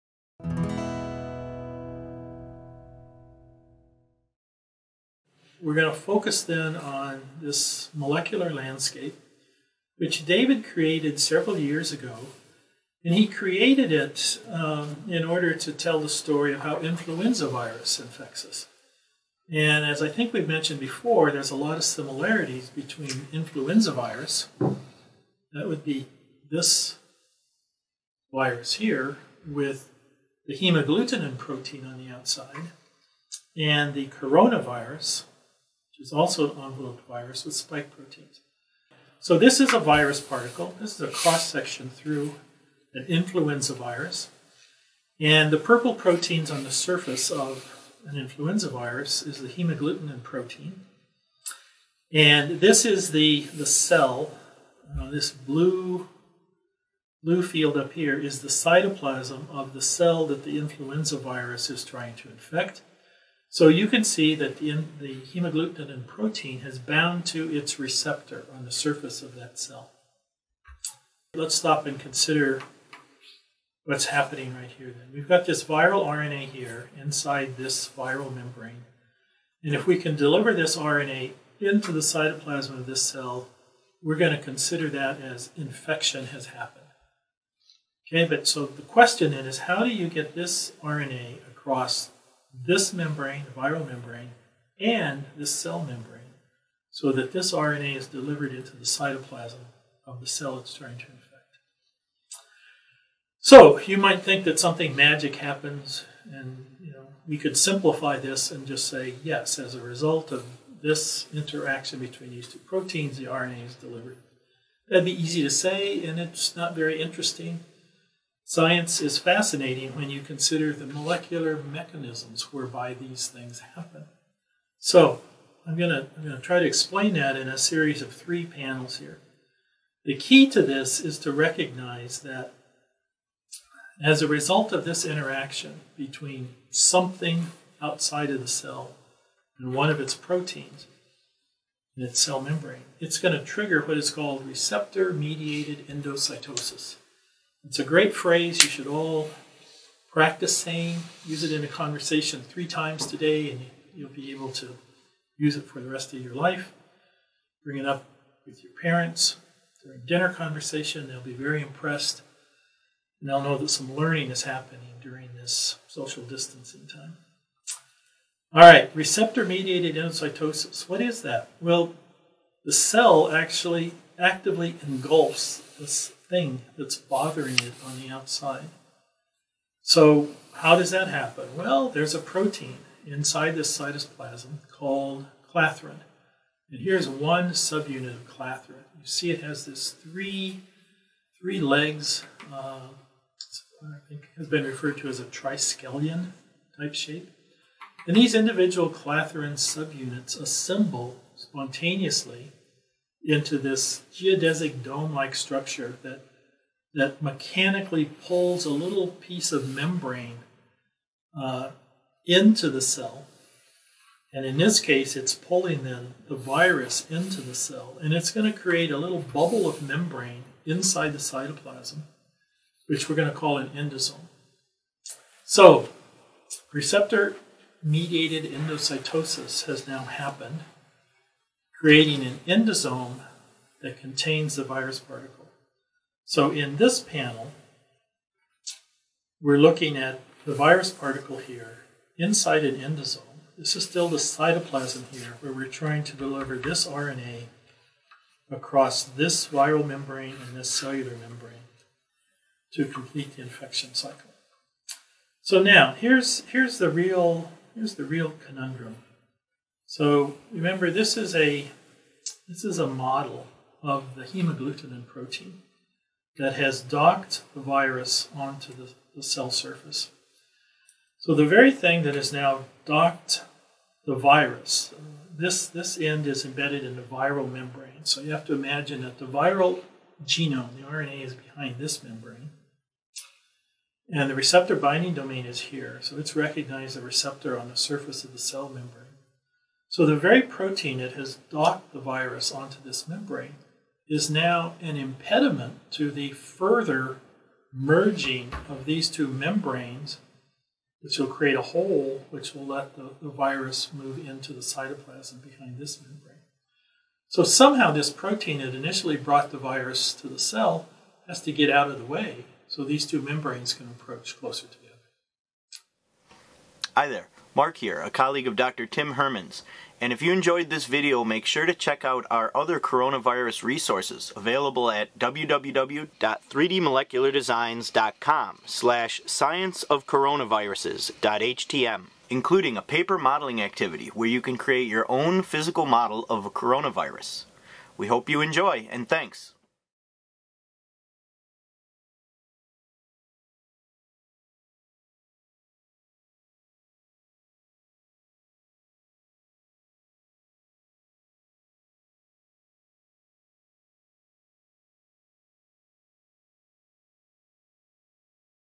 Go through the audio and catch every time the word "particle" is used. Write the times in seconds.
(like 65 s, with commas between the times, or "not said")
40 s, 234 s, 240 s.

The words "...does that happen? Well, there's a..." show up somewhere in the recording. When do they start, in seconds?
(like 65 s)
180 s.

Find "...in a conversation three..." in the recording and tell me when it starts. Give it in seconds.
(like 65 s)
151 s.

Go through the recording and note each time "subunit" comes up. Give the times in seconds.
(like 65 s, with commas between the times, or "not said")
187 s, 199 s.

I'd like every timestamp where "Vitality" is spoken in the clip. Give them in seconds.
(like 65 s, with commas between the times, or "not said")
not said.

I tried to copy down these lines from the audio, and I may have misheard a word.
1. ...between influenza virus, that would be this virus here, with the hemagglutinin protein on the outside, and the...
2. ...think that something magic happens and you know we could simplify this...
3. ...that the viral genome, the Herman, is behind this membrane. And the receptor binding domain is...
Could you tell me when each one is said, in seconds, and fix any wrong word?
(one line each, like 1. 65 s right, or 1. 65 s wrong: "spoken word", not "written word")
1. 22 s right
2. 104 s right
3. 279 s wrong: "RNA", not "Herman".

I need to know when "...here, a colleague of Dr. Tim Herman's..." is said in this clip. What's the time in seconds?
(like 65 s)
317 s.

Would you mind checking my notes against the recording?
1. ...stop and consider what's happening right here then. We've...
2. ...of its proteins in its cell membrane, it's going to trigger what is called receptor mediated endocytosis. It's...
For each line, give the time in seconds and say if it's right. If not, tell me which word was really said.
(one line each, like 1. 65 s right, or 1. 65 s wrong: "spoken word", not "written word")
1. 71 s right
2. 139 s right.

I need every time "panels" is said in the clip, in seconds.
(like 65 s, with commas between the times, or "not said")
128 s, 236 s.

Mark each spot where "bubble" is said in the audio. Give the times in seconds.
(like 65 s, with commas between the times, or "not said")
219 s.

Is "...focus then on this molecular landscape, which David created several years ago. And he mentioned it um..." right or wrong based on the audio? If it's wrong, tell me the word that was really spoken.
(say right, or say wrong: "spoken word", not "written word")
wrong: "created", not "mentioned".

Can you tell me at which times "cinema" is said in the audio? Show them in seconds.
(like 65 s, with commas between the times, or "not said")
not said.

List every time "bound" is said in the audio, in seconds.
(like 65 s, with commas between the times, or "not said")
66 s.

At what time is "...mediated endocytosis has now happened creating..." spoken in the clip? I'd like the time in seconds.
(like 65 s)
227 s.